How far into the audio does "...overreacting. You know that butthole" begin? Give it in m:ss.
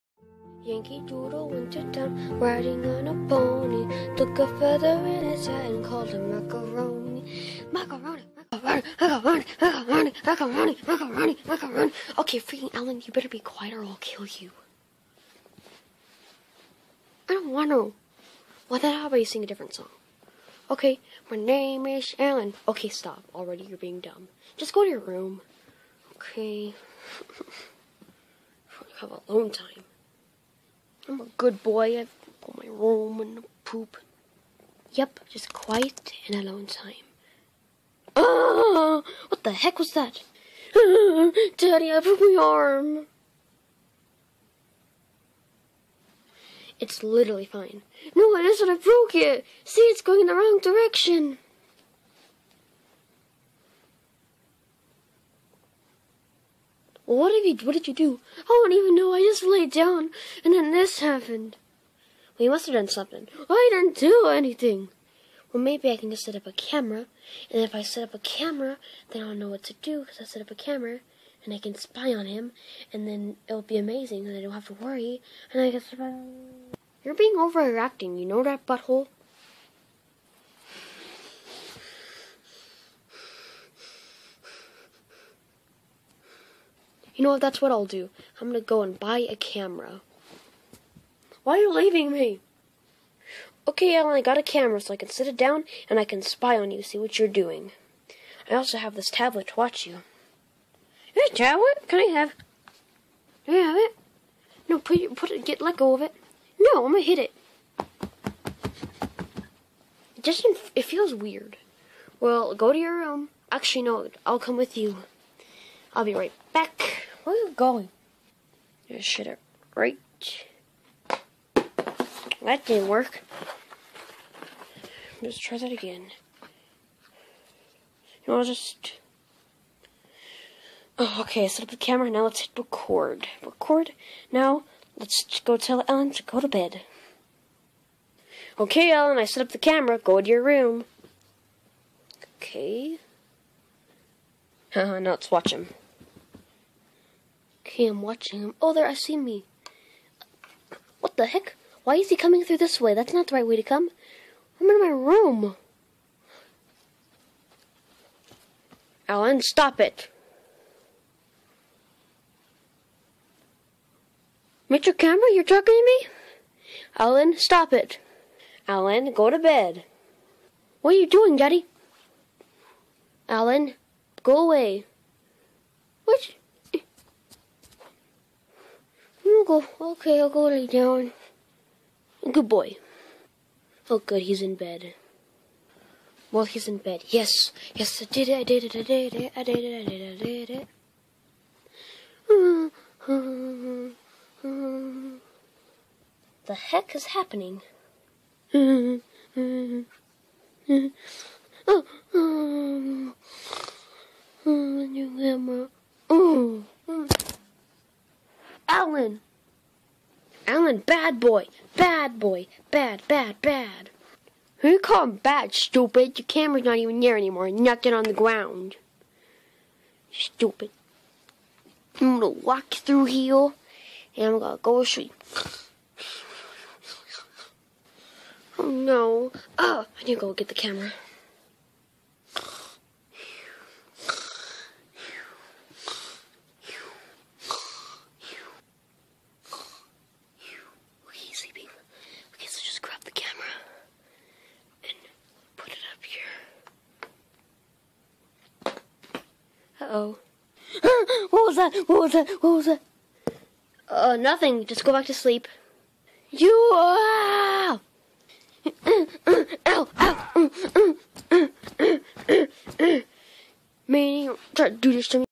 1:17.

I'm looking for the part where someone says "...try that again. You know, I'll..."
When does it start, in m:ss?
2:05.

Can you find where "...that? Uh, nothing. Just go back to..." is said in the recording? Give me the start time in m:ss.
4:12.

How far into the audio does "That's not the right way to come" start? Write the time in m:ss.
2:32.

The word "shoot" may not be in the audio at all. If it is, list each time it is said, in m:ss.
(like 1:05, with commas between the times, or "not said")
3:44.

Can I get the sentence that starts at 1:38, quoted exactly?
I also have this tablet to watch you.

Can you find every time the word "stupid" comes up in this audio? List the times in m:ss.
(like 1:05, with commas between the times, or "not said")
3:35, 3:40.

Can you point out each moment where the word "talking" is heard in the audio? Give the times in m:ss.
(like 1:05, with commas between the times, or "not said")
2:45.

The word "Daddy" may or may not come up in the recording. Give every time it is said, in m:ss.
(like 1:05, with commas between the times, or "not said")
0:41, 2:51.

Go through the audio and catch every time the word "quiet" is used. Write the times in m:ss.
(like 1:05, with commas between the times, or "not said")
0:13, 0:35.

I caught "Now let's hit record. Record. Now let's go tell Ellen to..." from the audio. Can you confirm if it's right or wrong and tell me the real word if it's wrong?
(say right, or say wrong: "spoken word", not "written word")
right.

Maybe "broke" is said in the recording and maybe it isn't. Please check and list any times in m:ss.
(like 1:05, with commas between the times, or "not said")
0:42, 0:48.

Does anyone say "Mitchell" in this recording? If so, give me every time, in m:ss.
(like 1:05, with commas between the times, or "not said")
2:44.